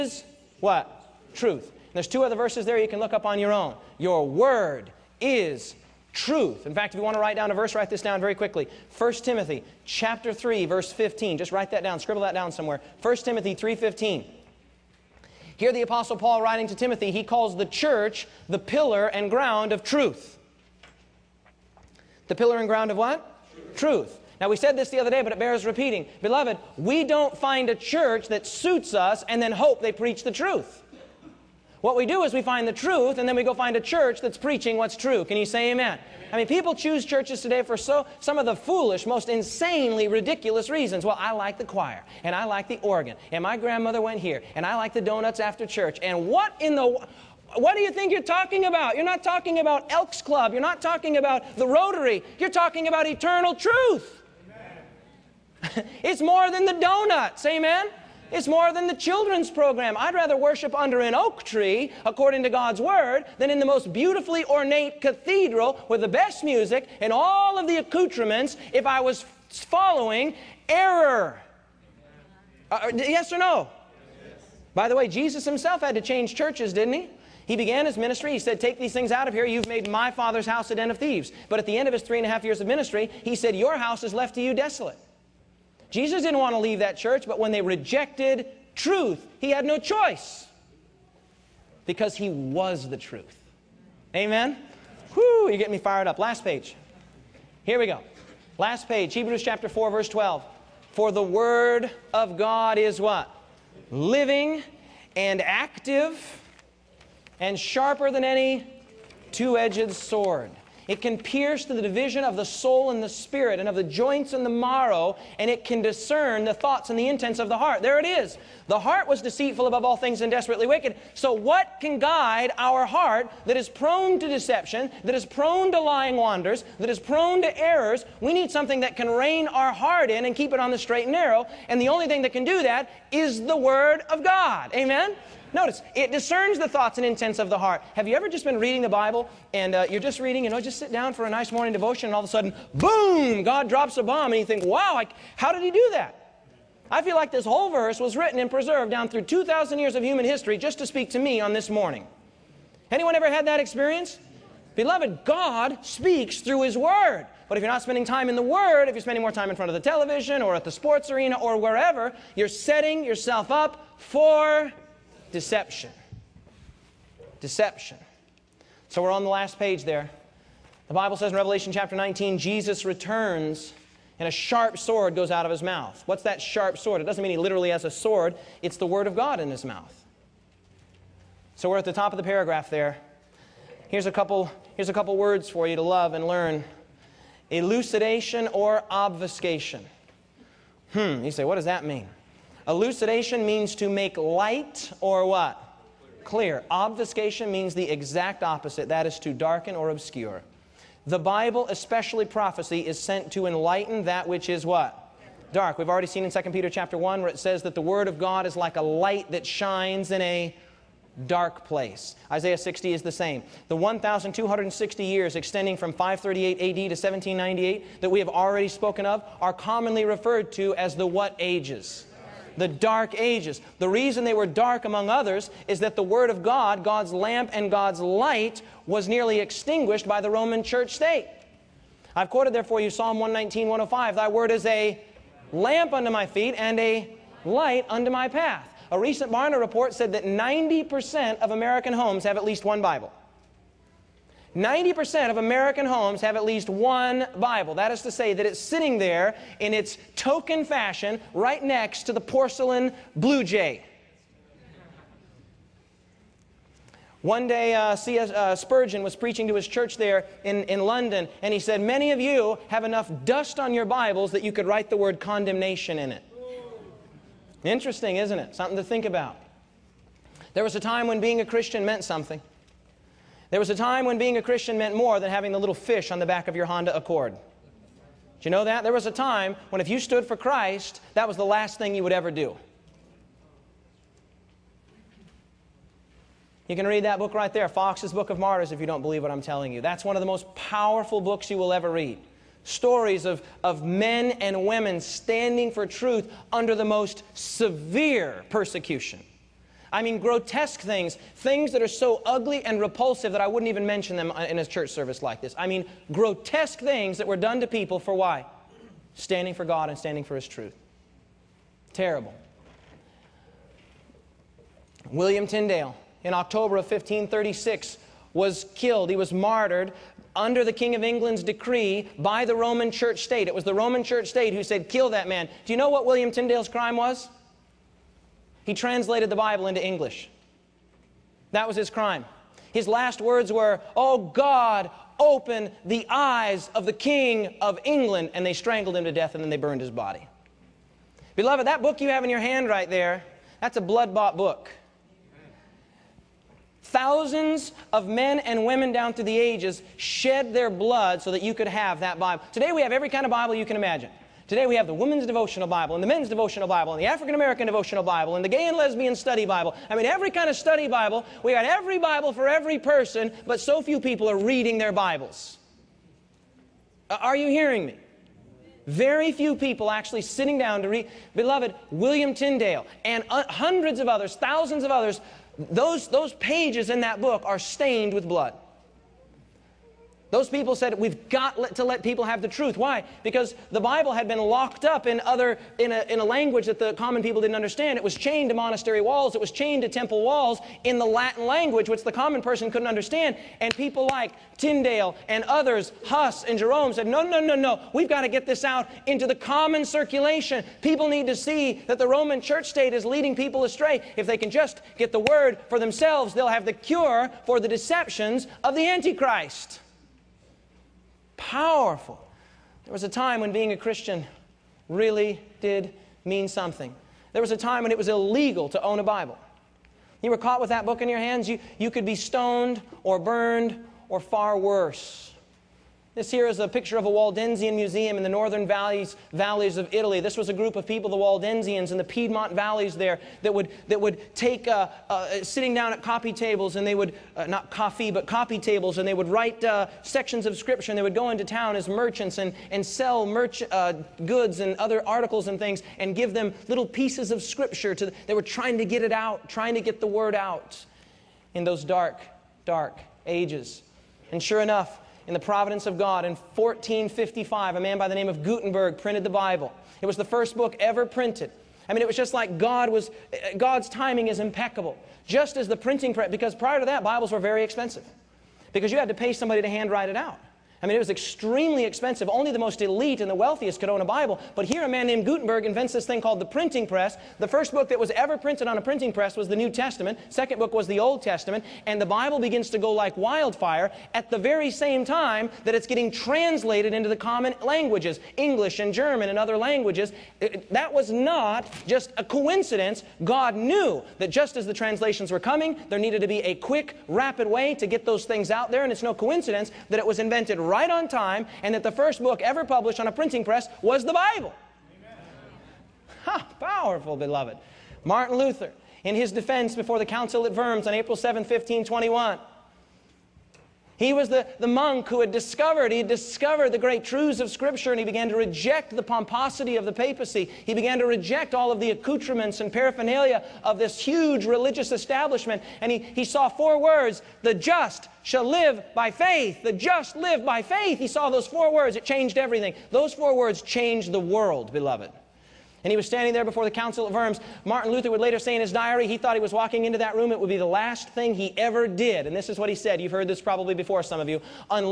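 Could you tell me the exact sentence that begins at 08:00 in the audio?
Second book was the Old Testament.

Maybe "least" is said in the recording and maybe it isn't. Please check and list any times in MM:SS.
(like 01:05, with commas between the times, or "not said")
04:02, 04:06.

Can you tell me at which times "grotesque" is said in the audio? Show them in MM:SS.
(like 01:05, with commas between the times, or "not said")
05:00, 05:06.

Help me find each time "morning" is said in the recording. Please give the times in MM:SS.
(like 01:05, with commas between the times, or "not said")
02:21, 02:31.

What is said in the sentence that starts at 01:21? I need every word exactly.
But at the end of his three and a half years of ministry, he said, Your house is left to you desolate.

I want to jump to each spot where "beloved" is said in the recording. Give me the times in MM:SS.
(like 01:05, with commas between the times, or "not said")
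00:26, 02:34, 05:41, 06:11, 08:27, 08:54.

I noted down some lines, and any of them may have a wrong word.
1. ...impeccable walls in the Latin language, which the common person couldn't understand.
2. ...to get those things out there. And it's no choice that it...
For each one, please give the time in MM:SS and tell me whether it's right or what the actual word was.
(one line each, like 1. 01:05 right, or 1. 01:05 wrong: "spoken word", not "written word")
1. 06:29 wrong: "temple", not "impeccable"
2. 08:17 wrong: "coincidence", not "choice".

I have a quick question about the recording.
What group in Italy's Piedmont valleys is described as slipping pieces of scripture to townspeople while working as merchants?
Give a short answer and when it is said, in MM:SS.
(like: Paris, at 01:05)
Waldensians, at 07:11.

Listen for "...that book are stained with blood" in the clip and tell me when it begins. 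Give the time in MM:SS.
06:17.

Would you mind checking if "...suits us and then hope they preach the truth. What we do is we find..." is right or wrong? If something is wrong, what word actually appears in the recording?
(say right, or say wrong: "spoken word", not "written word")
right.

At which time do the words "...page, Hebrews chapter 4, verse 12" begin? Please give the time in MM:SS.
01:38.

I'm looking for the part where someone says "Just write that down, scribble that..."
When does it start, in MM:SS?
00:11.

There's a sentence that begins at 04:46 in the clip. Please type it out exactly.
You can read that book right there, Fox's Book of Martyrs, if you don't believe what I'm telling you.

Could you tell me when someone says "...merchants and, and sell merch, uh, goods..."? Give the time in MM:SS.
07:21.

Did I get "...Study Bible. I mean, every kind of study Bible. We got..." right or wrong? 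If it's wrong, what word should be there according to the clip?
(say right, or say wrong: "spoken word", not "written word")
right.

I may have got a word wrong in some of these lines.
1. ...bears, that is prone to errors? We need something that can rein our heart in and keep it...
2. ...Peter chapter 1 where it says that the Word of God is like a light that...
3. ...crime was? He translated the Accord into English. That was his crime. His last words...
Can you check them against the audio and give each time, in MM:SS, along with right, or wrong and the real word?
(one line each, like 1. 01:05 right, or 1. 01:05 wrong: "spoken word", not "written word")
1. 02:06 wrong: "wanders", not "bears"
2. 03:26 right
3. 05:26 wrong: "Bible", not "Accord".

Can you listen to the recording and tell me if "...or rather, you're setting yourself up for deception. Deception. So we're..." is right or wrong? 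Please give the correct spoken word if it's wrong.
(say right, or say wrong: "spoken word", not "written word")
wrong: "wherever", not "rather".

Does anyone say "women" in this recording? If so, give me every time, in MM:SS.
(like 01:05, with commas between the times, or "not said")
04:54, 05:48, 05:54.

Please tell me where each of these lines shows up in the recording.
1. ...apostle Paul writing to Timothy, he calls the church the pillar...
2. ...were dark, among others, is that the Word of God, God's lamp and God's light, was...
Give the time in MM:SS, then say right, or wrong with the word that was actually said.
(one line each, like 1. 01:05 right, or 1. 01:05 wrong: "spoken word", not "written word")
1. 00:15 right
2. 03:44 right.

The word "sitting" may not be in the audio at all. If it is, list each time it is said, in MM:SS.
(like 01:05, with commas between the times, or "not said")
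04:08, 06:10, 07:15.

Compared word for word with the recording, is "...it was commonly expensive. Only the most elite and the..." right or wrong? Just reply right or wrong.
wrong.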